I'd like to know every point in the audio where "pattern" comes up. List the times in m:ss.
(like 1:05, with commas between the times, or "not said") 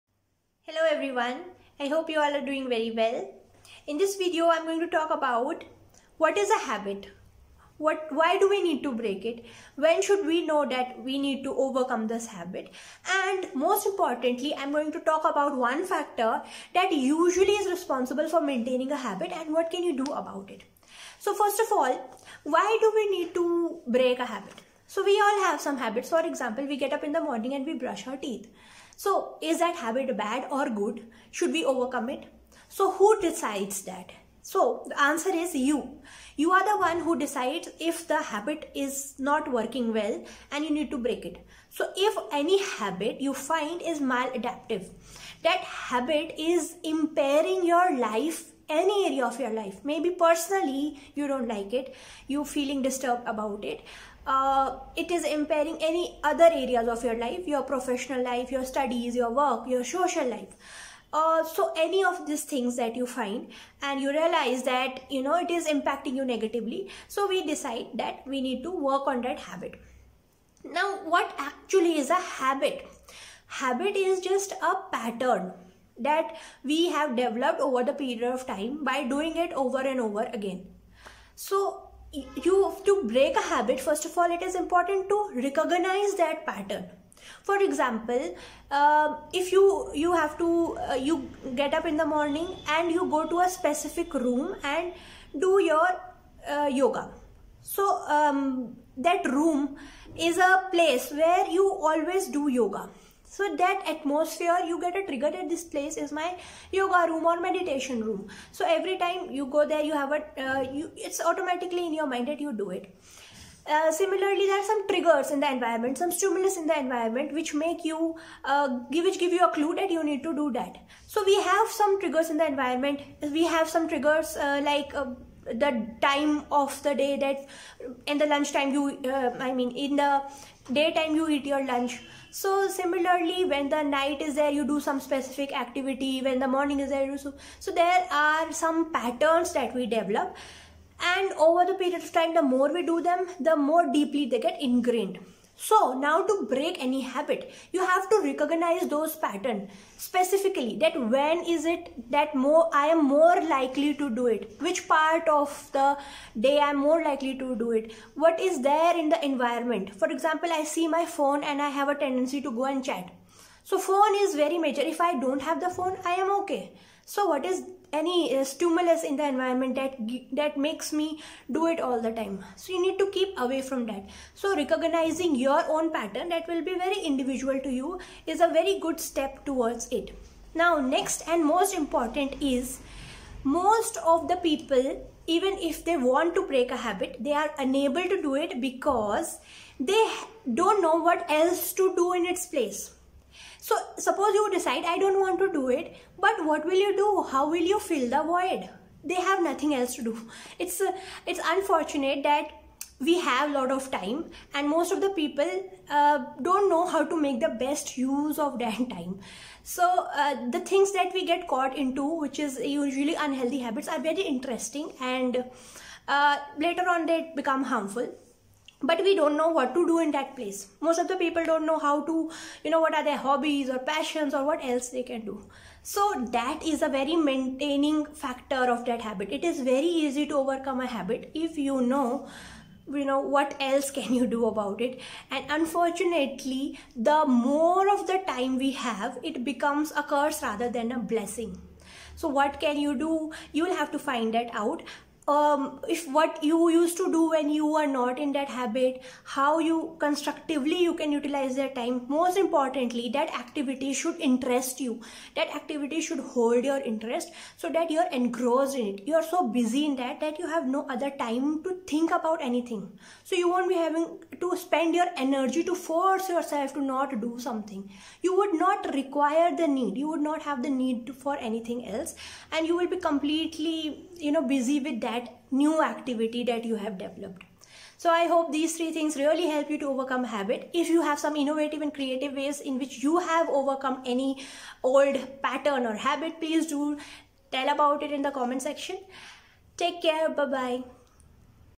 1:14, 1:26, 2:18, 2:29, 2:55, 4:45.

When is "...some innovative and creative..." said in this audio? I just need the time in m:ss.
4:41.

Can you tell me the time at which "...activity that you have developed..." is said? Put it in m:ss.
4:35.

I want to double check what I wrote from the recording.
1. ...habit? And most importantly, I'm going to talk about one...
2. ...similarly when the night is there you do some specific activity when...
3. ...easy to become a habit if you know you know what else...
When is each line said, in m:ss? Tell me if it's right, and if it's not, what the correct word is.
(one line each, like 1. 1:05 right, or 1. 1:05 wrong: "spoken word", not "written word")
1. 0:12 right
2. 2:12 right
3. 3:50 wrong: "overcome", not "become".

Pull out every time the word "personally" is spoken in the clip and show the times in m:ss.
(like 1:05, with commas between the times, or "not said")
0:50.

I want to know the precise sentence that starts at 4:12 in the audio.
Most importantly, that activity should interest you.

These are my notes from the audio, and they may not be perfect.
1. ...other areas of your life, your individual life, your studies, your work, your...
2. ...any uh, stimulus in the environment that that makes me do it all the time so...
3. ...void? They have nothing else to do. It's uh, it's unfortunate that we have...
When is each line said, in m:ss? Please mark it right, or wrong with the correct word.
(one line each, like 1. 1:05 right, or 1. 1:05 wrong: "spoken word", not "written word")
1. 0:56 wrong: "professional", not "individual"
2. 2:47 right
3. 3:18 right.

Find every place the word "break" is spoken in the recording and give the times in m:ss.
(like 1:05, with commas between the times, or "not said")
0:08, 0:23, 0:40, 1:23, 2:26, 3:06.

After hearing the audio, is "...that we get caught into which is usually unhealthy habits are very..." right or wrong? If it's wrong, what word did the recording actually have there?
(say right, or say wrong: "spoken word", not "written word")
right.